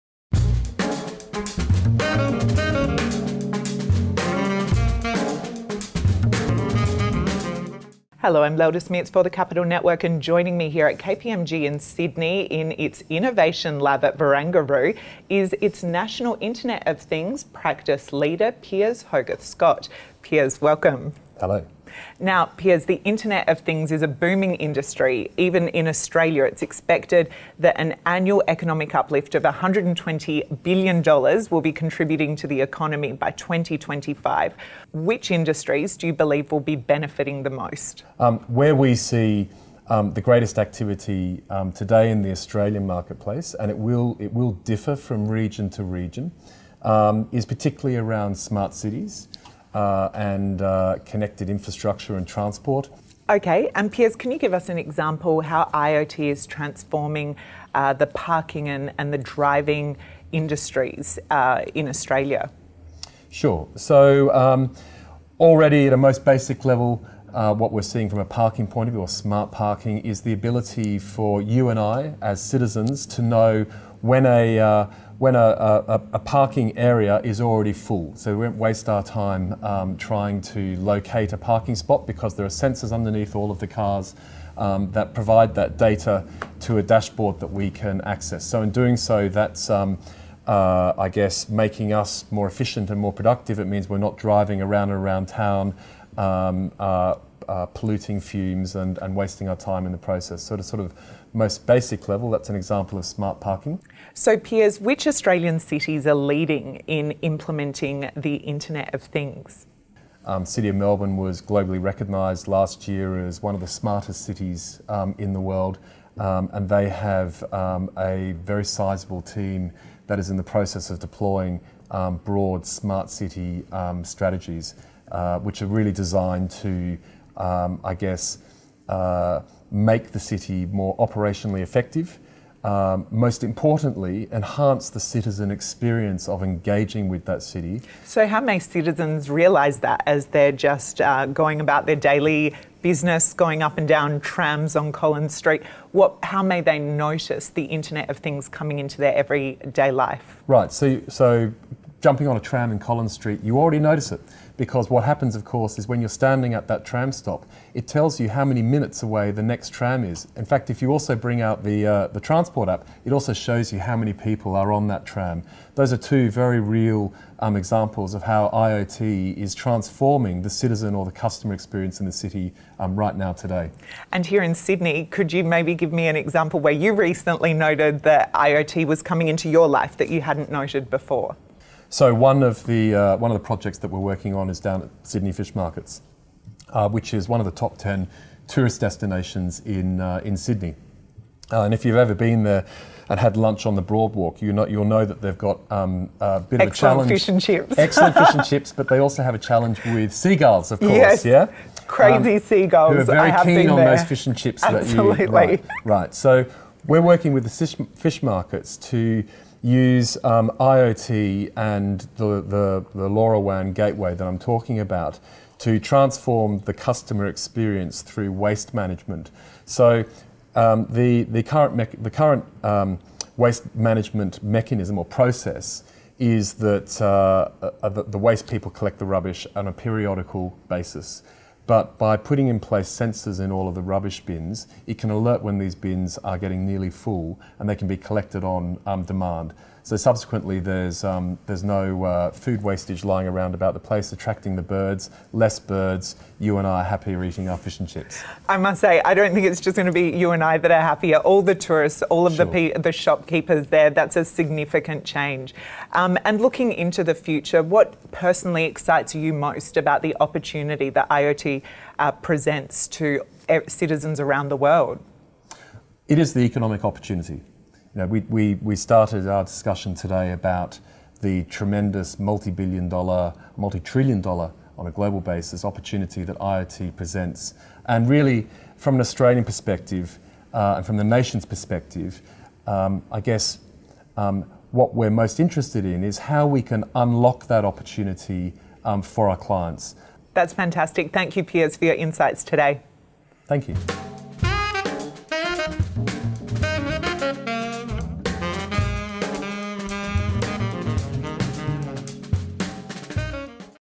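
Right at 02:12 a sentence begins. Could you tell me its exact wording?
Um, most importantly, enhance the citizen experience of engaging with that city.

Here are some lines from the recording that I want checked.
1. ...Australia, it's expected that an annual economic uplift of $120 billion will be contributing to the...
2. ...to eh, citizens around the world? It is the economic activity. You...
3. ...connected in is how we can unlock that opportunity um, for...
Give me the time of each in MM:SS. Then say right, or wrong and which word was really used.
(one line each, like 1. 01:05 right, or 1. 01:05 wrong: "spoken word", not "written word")
1. 00:25 right
2. 04:22 wrong: "opportunity", not "activity"
3. 04:45 wrong: "interested", not "connected".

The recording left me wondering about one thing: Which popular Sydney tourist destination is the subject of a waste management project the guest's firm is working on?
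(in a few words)
Sydney Fish Markets.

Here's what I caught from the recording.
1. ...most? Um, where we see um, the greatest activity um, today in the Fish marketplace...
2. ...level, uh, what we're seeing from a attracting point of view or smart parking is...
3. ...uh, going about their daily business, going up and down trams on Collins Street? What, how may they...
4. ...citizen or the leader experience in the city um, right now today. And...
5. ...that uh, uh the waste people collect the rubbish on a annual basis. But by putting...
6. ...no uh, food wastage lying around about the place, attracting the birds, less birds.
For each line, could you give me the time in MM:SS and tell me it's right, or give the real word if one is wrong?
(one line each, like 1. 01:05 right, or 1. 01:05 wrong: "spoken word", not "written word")
1. 00:37 wrong: "Australian", not "Fish"
2. 01:06 wrong: "parking", not "attracting"
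3. 02:21 right
4. 02:50 wrong: "customer", not "leader"
5. 03:46 wrong: "periodical", not "annual"
6. 04:01 right.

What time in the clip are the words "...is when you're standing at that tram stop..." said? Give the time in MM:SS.
02:35.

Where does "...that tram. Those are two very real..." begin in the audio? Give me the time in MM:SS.
02:44.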